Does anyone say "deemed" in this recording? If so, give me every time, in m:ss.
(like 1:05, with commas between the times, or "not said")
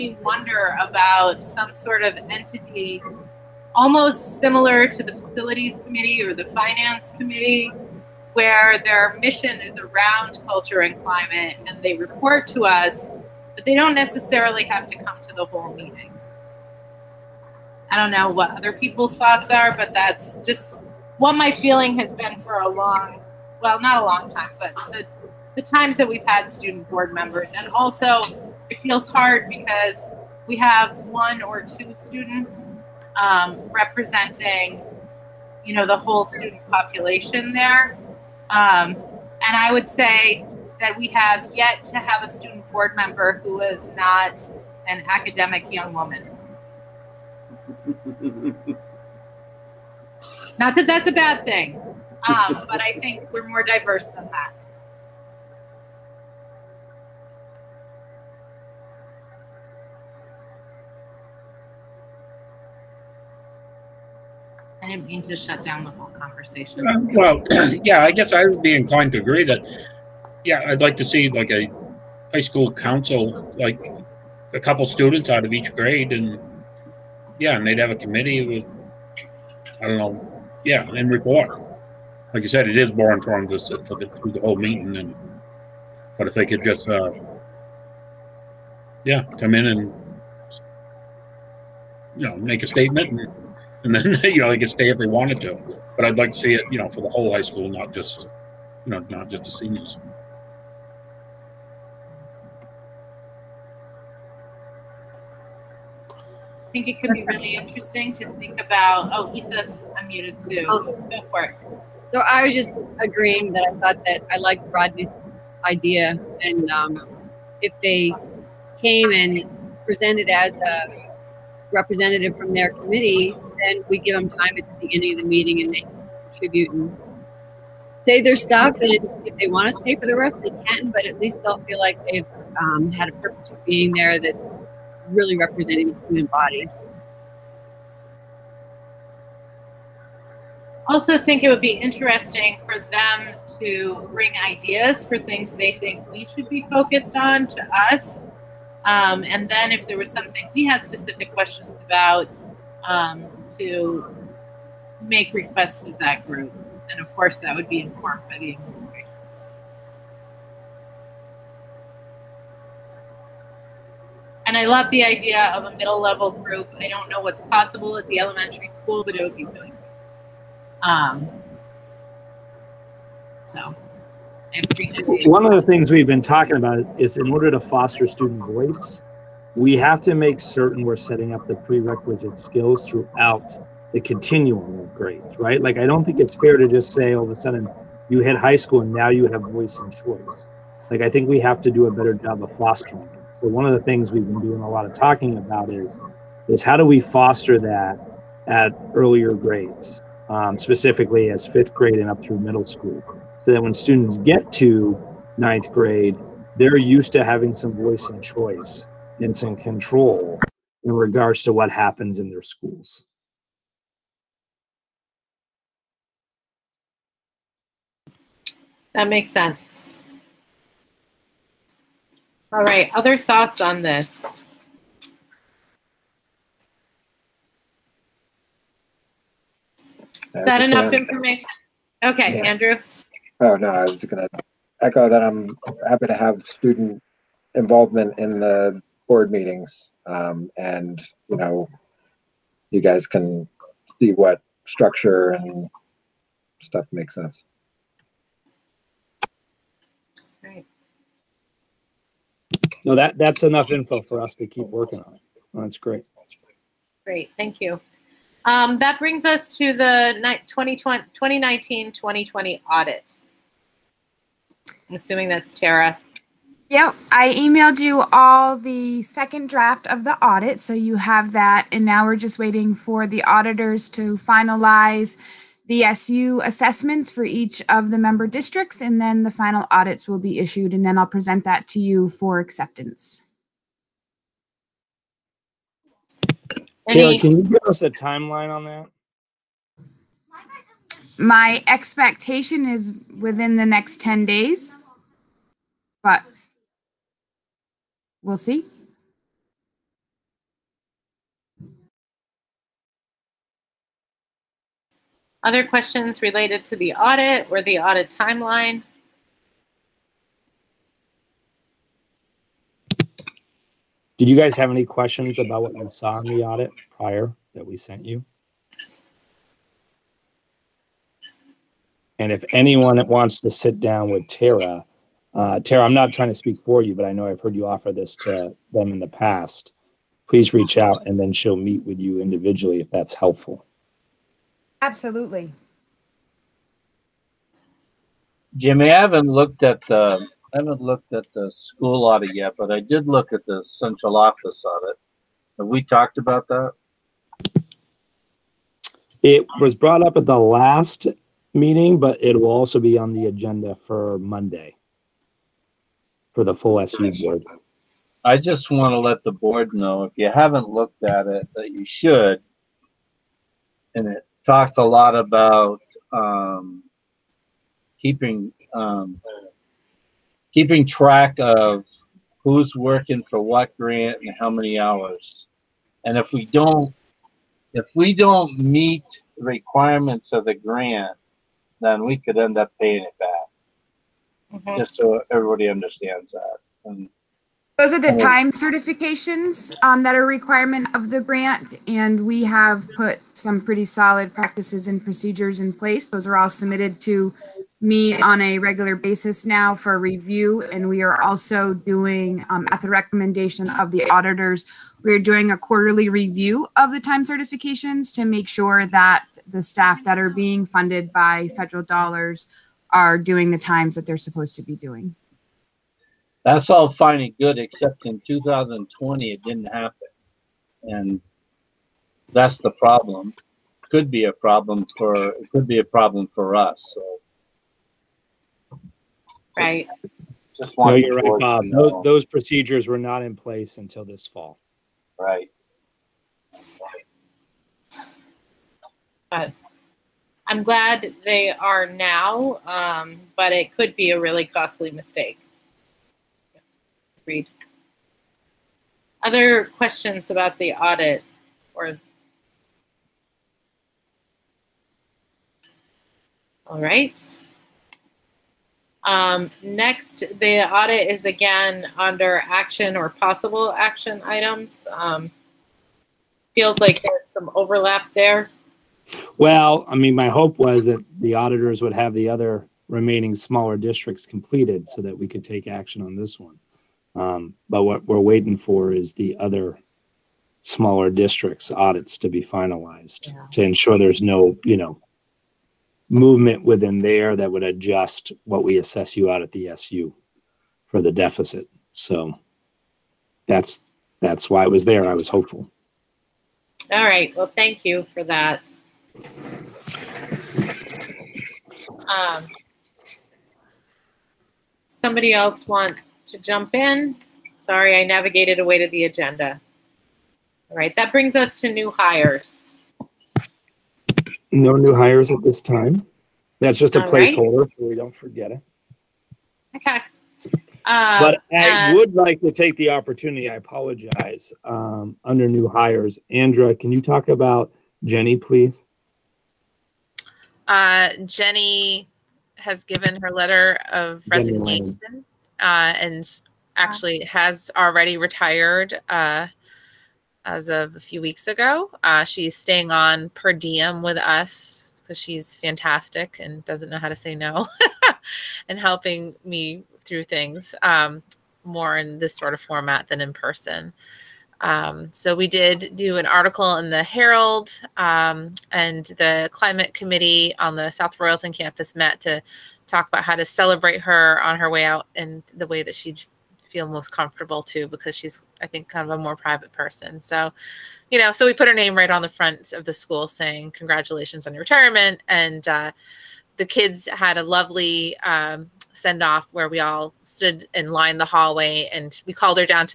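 not said.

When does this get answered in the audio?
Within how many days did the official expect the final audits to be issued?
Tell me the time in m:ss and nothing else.
4:54.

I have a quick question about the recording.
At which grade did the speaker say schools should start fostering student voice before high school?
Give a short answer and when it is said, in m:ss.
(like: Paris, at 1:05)
fifth grade, at 3:21.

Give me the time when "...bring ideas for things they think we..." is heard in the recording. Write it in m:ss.
2:24.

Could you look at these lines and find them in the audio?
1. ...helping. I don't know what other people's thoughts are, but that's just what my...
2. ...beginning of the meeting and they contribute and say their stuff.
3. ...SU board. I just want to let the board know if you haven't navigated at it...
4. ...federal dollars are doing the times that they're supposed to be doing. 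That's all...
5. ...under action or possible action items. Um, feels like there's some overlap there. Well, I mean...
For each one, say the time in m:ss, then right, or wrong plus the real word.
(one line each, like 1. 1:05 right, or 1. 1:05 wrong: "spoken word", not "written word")
1. 0:15 wrong: "meeting", not "helping"
2. 2:04 right
3. 5:56 wrong: "looked", not "navigated"
4. 6:51 right
5. 7:41 right.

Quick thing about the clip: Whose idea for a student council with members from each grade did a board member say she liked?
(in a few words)
Rodney's.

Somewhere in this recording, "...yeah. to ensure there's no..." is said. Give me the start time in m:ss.
8:03.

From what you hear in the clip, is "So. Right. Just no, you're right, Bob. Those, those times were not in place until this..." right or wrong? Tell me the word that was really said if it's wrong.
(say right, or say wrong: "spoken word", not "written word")
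wrong: "procedures", not "times".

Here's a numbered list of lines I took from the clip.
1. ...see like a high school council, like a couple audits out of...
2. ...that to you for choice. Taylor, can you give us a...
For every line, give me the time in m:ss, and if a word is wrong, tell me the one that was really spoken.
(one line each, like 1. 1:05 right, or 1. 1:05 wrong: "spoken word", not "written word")
1. 1:11 wrong: "students", not "audits"
2. 4:41 wrong: "acceptance", not "choice".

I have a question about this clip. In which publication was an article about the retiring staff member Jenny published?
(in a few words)
the Herald.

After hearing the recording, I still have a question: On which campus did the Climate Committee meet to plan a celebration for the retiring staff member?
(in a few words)
South Royalton.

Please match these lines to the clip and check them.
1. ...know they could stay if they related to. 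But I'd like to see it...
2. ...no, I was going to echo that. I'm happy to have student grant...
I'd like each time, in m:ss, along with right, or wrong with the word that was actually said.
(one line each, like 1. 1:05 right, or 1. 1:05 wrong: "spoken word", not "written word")
1. 1:34 wrong: "wanted", not "related"
2. 3:53 wrong: "involvement", not "grant".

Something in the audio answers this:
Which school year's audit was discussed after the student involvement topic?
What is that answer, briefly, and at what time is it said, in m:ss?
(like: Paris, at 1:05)
2019-2020, at 4:20.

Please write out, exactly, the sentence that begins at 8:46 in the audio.
Andrea, can you talk about Jenny, please?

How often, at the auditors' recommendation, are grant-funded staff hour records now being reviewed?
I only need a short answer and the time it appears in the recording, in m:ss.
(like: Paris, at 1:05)
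quarterly, at 6:45.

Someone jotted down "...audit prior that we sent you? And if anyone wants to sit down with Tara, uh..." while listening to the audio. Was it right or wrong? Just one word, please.
right.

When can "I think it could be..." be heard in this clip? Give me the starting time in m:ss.
1:46.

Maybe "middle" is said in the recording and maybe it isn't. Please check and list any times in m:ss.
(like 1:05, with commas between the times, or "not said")
2:45, 3:22.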